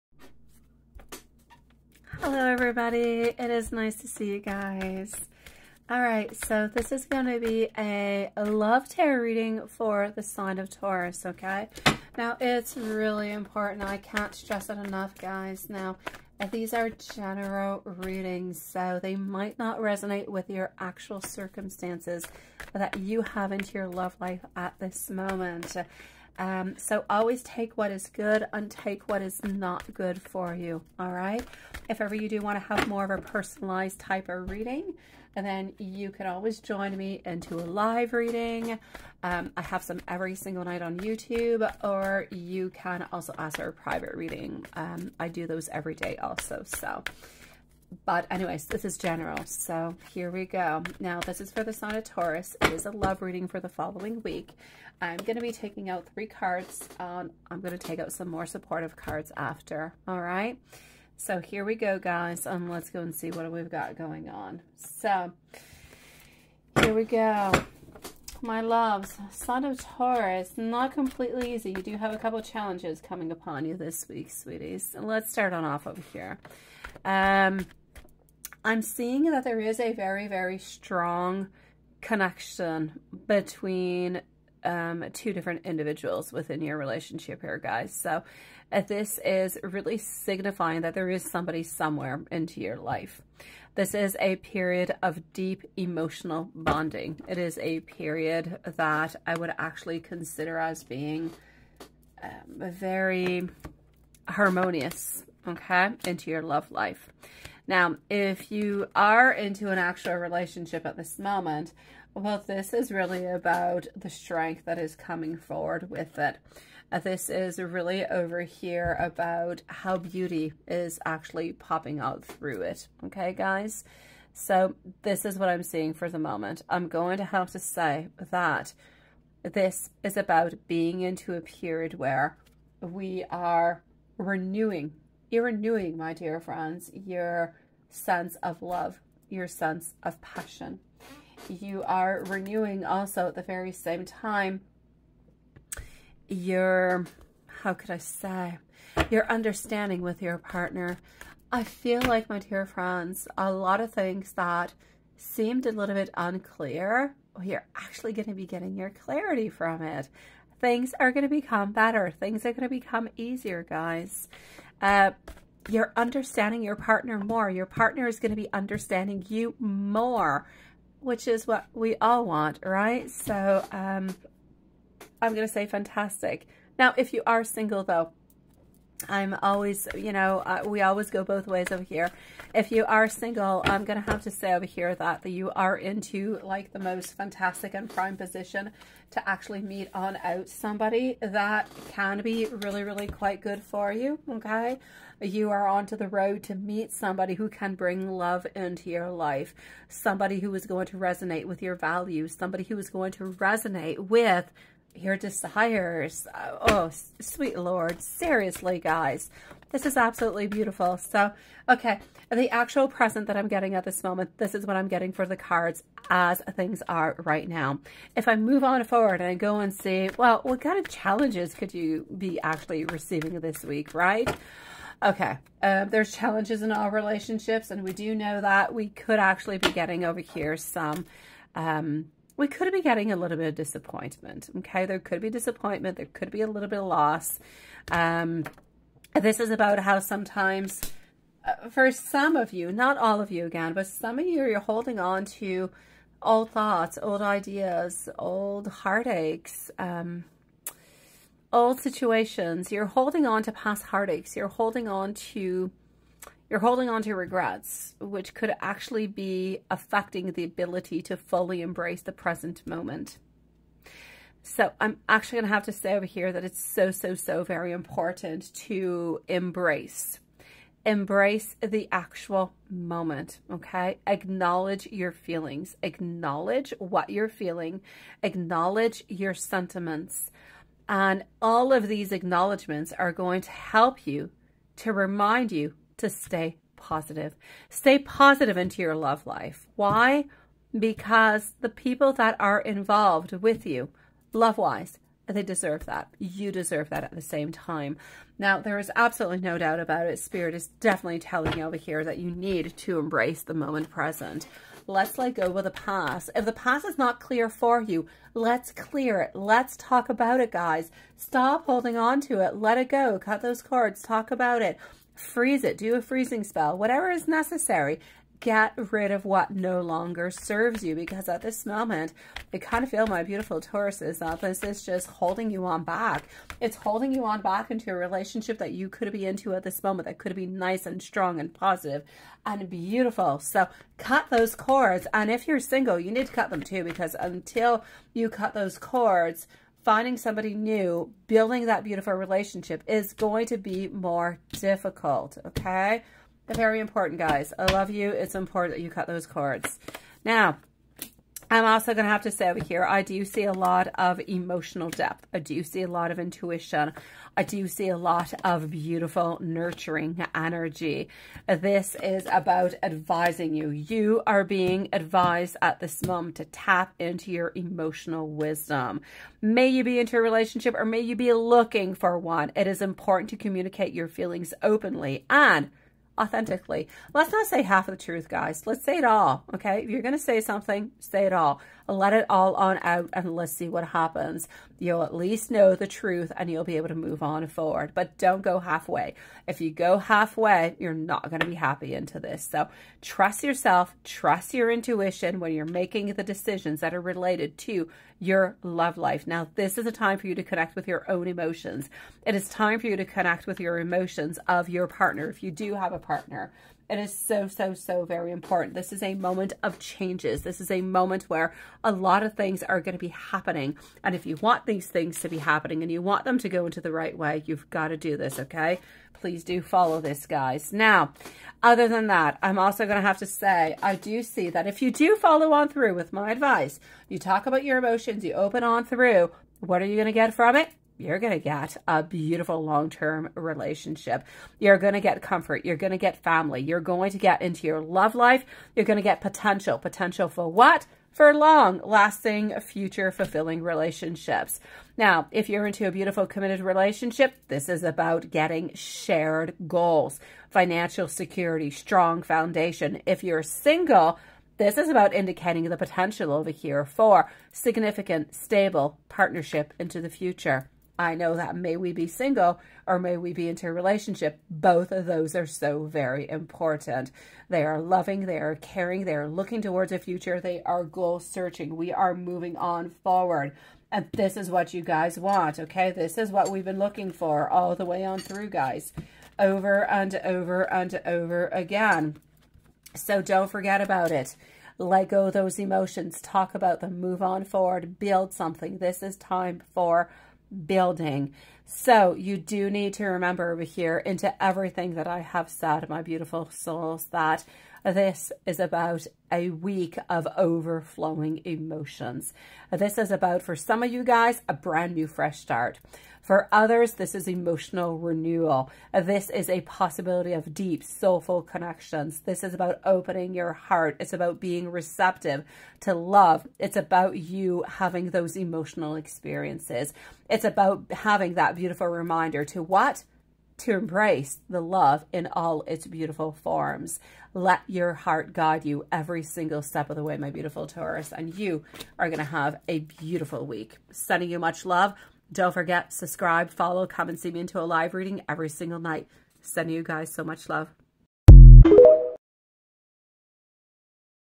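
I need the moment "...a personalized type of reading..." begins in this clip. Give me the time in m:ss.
0:33.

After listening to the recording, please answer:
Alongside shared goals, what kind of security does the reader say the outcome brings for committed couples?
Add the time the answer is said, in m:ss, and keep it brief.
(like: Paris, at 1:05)
financial security, at 7:30.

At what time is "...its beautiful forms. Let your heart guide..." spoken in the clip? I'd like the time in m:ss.
8:45.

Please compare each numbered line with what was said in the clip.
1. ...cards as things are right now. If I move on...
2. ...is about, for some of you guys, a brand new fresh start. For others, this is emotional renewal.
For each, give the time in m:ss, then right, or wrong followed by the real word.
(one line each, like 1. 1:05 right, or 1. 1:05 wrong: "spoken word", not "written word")
1. 3:35 right
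2. 8:22 right.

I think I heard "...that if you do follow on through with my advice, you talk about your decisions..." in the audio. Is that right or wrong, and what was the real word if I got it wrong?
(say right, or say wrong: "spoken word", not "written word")
wrong: "emotions", not "decisions".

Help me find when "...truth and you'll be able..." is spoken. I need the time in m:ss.
6:25.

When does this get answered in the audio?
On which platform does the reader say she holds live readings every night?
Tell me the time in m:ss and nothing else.
0:40.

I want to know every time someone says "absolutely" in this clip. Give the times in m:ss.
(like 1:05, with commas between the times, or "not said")
3:29, 4:58.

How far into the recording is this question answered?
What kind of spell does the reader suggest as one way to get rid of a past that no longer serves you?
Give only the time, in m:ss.
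5:16.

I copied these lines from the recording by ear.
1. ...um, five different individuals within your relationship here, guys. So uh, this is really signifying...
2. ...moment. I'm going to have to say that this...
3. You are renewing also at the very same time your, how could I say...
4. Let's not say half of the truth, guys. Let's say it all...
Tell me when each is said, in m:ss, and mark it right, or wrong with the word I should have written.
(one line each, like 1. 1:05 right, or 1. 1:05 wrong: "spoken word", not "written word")
1. 1:24 wrong: "two", not "five"
2. 2:06 right
3. 2:21 right
4. 6:17 right.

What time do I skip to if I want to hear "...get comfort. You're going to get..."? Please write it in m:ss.
7:15.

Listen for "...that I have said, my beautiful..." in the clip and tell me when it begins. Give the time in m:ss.
8:14.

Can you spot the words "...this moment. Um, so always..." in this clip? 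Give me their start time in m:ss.
0:24.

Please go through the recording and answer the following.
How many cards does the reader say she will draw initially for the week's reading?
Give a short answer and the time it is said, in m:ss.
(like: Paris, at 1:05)
3, at 0:56.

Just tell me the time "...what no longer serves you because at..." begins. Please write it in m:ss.
5:19.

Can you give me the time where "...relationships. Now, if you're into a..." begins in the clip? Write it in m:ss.
7:23.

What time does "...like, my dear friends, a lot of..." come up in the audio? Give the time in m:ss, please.
2:32.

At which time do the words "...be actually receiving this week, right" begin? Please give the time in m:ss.
3:42.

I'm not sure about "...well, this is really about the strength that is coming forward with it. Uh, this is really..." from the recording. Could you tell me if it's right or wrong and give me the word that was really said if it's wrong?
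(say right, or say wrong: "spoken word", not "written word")
right.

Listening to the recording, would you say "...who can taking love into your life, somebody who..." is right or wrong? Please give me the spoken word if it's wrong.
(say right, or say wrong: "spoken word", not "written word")
wrong: "bring", not "taking".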